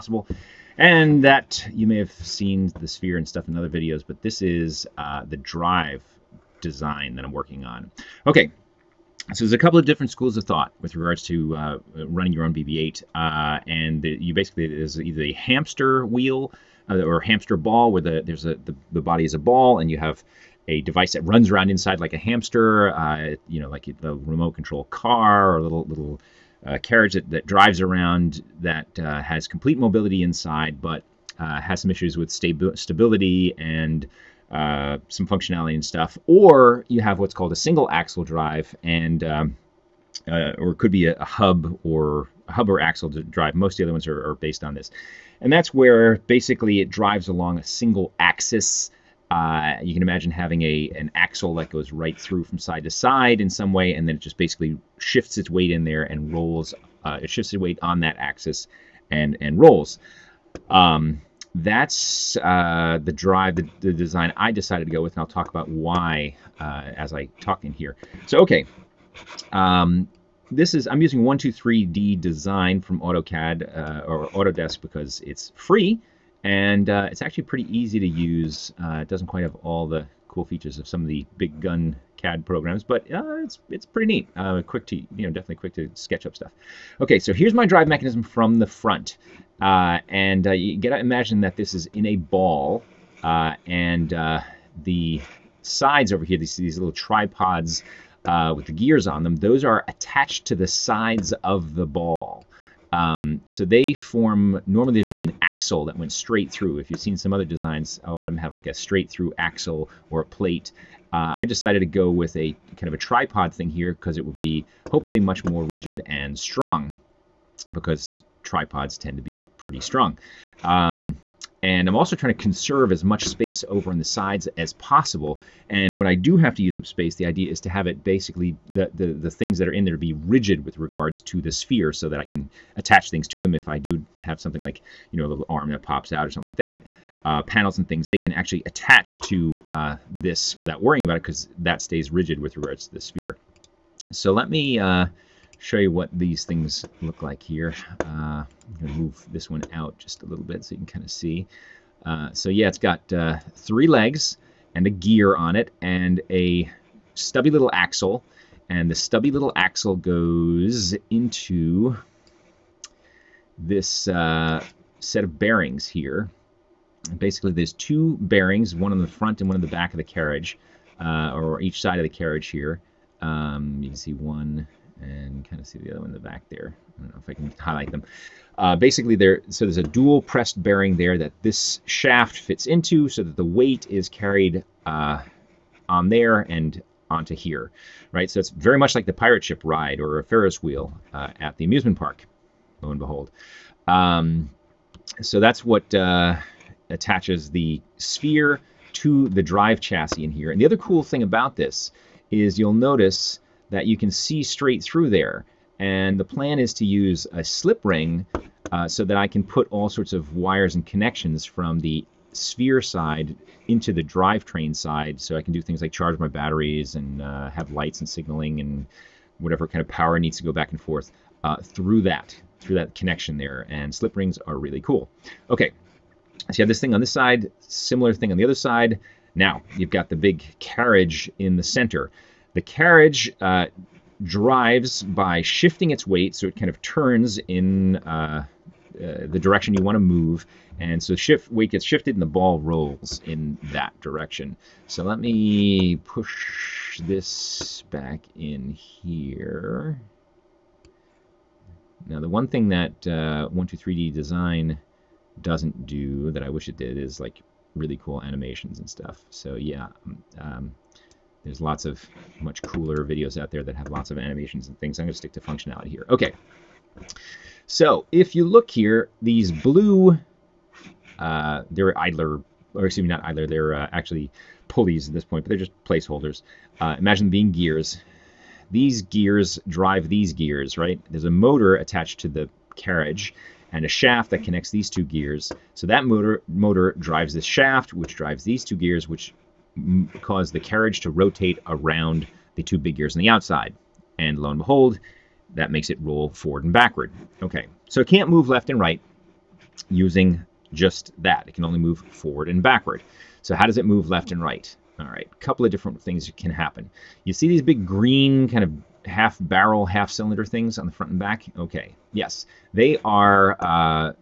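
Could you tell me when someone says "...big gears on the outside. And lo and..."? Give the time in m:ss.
4:52.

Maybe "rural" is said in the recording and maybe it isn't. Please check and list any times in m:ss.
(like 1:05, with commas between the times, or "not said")
not said.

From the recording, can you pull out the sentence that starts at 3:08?
So it's very much like the pirate ship ride or a Ferris wheel uh, at the amusement park.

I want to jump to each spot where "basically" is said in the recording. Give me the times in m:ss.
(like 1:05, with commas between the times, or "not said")
0:14, 0:46, 0:54, 2:08, 2:47, 2:58.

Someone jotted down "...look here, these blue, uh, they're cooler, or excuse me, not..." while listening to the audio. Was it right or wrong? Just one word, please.
wrong.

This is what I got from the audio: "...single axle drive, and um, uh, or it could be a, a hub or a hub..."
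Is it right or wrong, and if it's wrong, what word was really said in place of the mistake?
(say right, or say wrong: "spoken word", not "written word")
right.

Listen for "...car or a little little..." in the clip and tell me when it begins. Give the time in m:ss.
0:24.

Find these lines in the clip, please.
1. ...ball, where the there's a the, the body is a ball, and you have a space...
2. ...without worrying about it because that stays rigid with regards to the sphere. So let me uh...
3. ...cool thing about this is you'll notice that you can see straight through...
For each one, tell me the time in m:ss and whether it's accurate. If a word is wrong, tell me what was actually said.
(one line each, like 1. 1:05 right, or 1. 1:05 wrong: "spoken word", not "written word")
1. 0:17 wrong: "device", not "space"
2. 2:20 right
3. 3:20 right.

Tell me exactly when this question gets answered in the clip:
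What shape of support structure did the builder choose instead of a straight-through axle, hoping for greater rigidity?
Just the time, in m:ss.
1:52.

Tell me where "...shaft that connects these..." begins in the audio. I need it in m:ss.
4:43.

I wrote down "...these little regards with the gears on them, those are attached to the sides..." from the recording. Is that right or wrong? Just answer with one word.
wrong.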